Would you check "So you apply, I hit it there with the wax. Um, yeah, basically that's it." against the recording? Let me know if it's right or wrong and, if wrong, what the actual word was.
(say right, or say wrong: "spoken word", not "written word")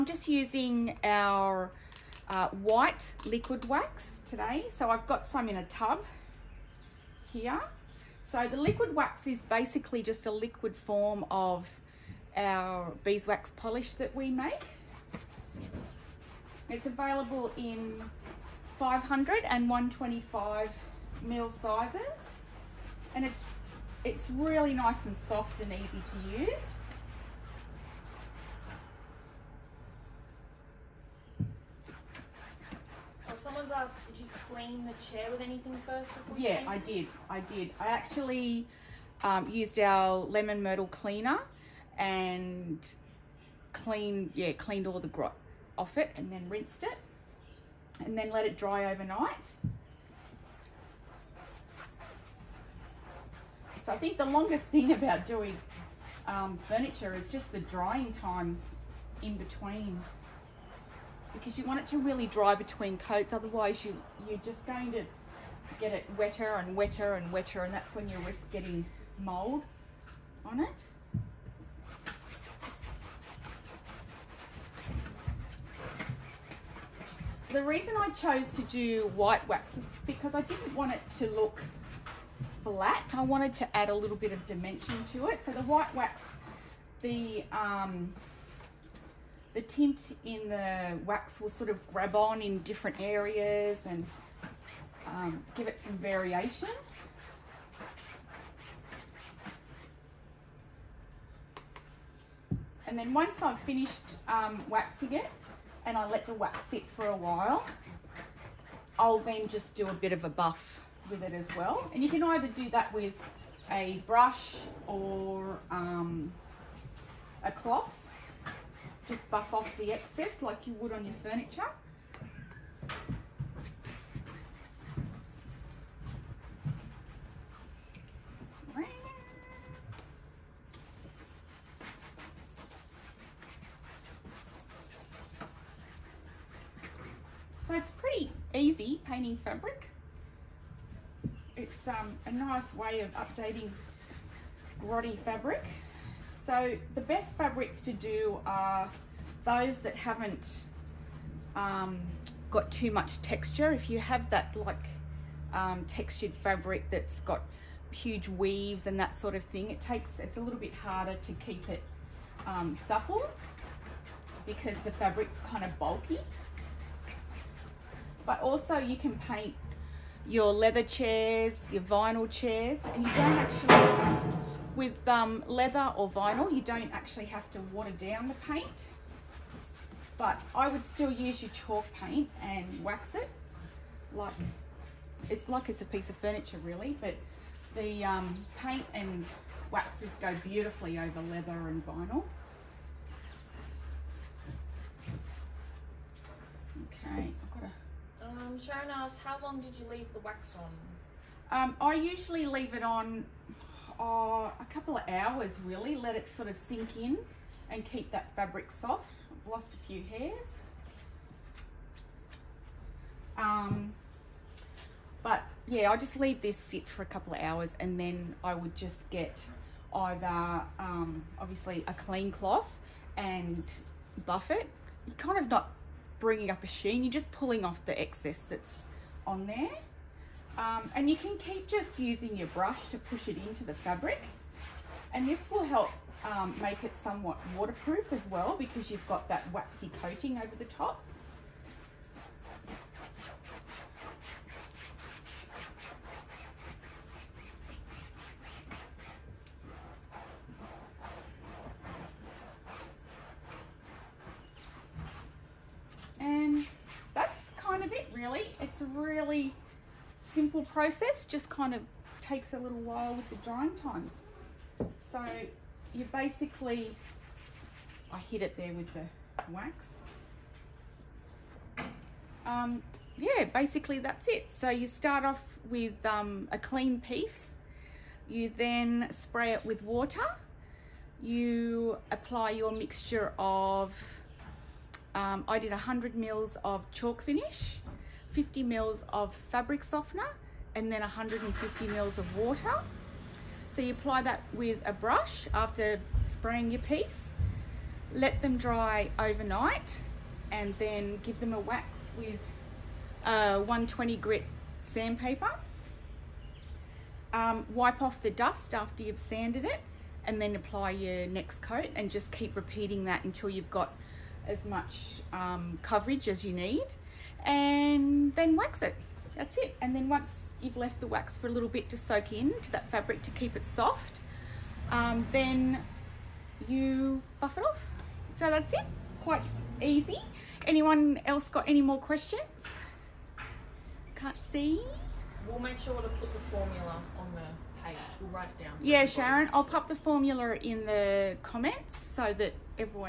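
wrong: "basically", not "apply".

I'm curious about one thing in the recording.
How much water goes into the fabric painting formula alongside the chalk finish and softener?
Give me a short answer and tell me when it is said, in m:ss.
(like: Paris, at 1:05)
150 ml, at 4:51.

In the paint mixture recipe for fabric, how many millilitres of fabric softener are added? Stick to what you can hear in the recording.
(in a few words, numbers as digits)
50 ml.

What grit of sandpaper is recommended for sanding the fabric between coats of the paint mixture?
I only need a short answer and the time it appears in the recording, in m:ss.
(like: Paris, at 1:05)
120, at 5:03.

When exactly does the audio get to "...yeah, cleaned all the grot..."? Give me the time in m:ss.
0:44.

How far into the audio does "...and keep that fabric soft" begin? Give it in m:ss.
3:27.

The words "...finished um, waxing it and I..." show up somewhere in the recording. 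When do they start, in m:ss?
1:43.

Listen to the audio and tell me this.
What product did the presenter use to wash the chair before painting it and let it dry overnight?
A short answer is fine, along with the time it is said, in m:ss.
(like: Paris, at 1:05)
Lemon myrtle cleaner, at 0:40.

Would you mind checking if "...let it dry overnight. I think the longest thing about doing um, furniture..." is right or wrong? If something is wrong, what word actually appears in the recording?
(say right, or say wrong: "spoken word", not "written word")
right.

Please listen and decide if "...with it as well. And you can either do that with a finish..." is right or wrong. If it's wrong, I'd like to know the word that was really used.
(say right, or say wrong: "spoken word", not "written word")
wrong: "brush", not "finish".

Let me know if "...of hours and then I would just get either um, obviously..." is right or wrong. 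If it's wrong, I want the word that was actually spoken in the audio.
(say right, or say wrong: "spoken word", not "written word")
right.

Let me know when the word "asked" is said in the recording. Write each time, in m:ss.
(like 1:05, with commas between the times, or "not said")
0:33, 3:18.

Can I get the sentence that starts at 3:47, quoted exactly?
You're just pulling off the excess that's on there.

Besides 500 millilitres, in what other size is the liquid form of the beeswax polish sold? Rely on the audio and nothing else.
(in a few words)
125 ml.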